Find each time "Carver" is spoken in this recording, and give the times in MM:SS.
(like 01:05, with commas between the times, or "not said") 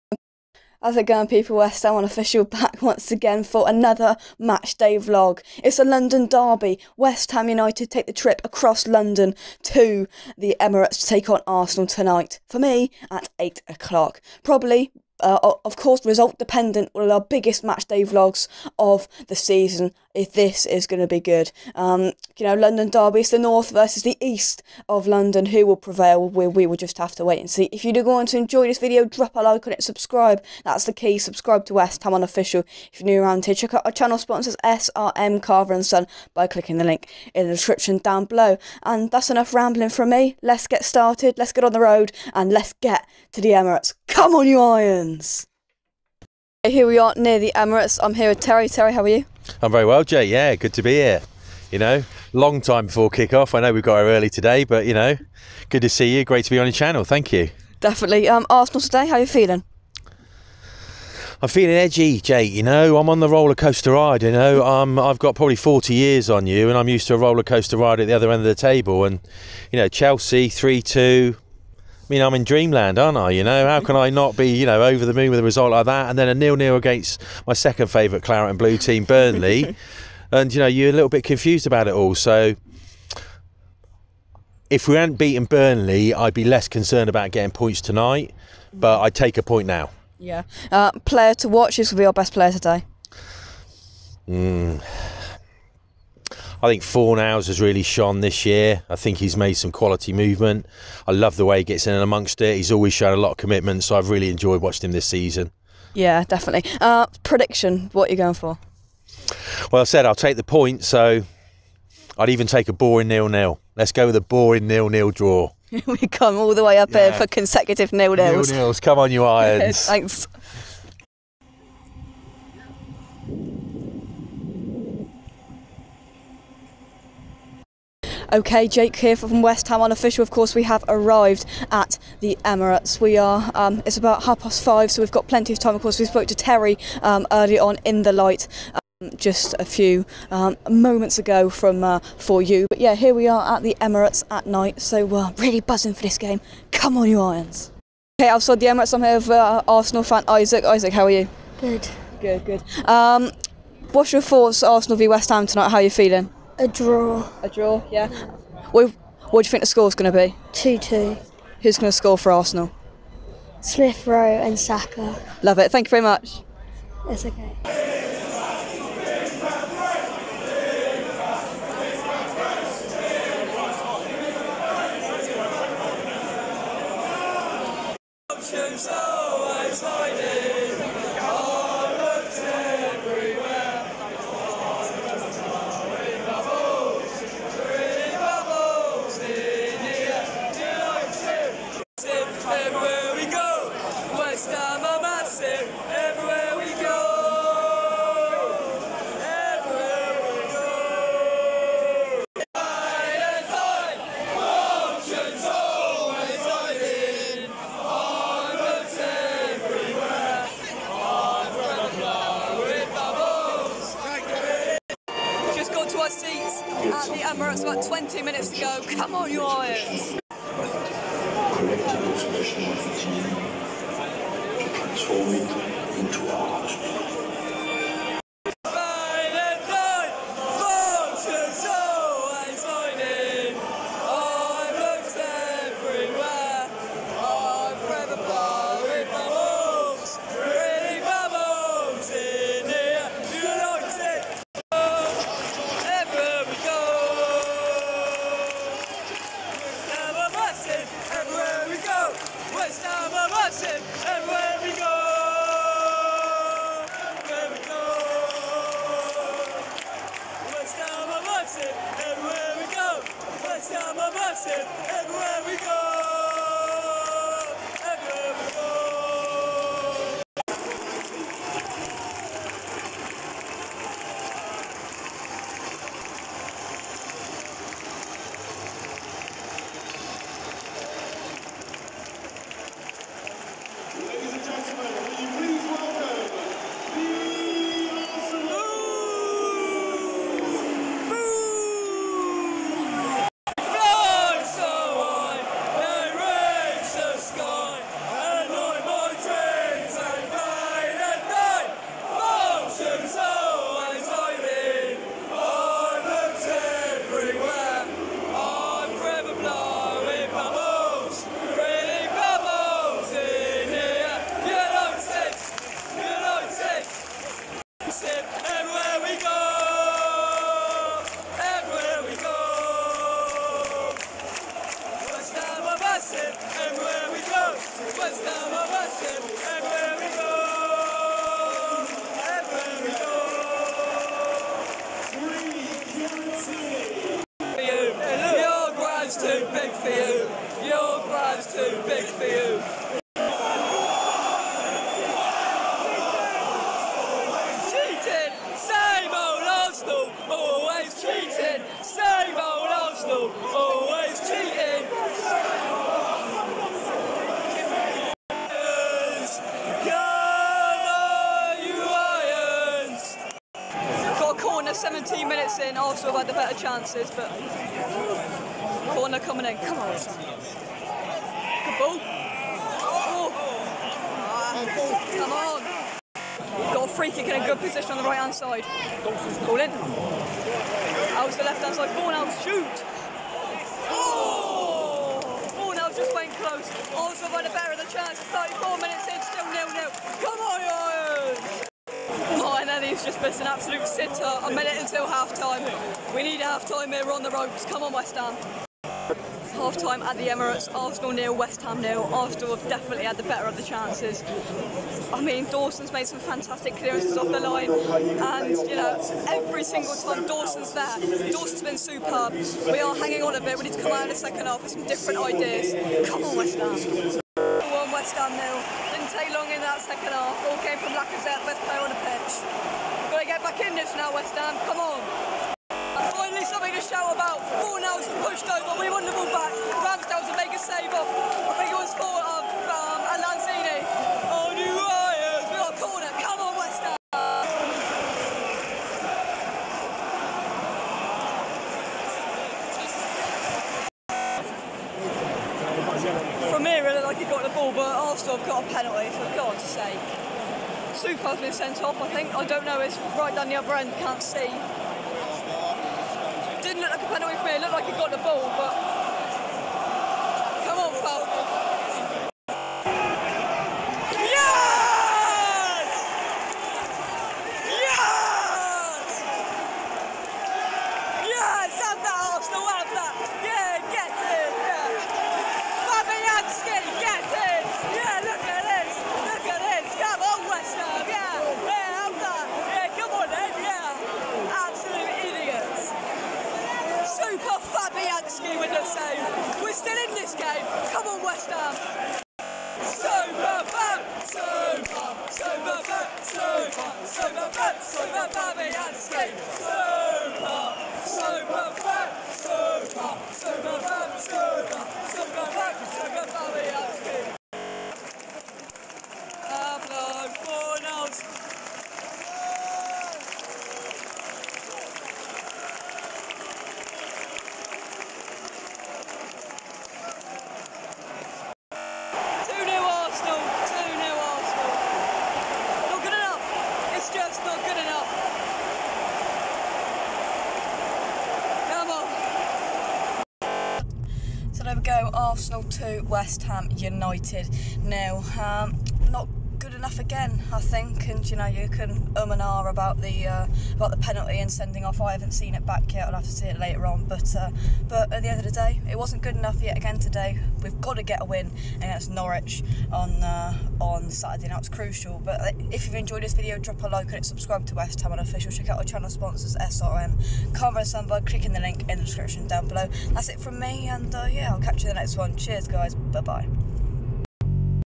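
00:35, 09:20.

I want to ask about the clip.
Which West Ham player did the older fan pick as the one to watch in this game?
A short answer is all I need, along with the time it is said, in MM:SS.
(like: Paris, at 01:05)
Fornals, at 01:36.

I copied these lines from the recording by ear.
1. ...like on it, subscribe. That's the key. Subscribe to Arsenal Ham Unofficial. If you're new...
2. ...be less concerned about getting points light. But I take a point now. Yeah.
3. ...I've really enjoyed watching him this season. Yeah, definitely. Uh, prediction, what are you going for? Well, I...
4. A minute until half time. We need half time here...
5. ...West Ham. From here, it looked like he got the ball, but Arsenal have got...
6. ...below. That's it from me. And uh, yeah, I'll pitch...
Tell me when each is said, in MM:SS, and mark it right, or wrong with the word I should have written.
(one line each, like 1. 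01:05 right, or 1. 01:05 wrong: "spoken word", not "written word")
1. 00:29 wrong: "West", not "Arsenal"
2. 01:26 wrong: "tonight", not "light"
3. 01:43 right
4. 06:34 right
5. 07:16 right
6. 09:22 wrong: "catch", not "pitch".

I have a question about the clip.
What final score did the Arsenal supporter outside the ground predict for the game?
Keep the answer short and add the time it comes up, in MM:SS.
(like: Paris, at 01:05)
2-2, at 02:40.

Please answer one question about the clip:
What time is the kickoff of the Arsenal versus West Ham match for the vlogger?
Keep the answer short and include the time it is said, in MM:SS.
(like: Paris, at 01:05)
8 o'clock, at 00:13.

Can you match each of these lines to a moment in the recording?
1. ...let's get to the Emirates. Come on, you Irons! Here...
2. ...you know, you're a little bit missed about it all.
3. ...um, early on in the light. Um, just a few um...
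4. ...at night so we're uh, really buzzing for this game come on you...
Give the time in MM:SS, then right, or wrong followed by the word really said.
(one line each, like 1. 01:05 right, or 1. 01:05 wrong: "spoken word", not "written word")
1. 00:42 right
2. 01:20 wrong: "confused", not "missed"
3. 02:17 right
4. 02:24 right.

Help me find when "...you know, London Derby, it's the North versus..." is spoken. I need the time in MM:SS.
00:22.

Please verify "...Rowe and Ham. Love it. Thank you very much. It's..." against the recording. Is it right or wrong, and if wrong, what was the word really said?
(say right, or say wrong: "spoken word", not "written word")
wrong: "Saka", not "Ham".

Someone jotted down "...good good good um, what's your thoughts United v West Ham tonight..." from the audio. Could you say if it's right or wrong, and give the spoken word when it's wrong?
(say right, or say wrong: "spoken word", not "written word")
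wrong: "Arsenal", not "United".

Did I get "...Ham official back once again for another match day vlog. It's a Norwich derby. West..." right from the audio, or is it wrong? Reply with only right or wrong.
wrong.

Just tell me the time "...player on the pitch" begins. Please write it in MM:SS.
07:01.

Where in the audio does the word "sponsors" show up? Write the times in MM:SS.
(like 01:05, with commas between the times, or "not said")
00:34, 09:19.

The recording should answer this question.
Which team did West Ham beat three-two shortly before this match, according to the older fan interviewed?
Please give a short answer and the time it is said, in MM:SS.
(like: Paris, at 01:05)
Chelsea, at 01:09.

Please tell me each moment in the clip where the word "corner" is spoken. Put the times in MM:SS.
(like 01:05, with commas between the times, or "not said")
06:04, 06:08, 07:15.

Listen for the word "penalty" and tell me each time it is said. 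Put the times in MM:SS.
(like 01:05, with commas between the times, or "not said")
07:28, 07:37, 09:03.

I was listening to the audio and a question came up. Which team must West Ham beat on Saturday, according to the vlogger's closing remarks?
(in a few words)
Norwich.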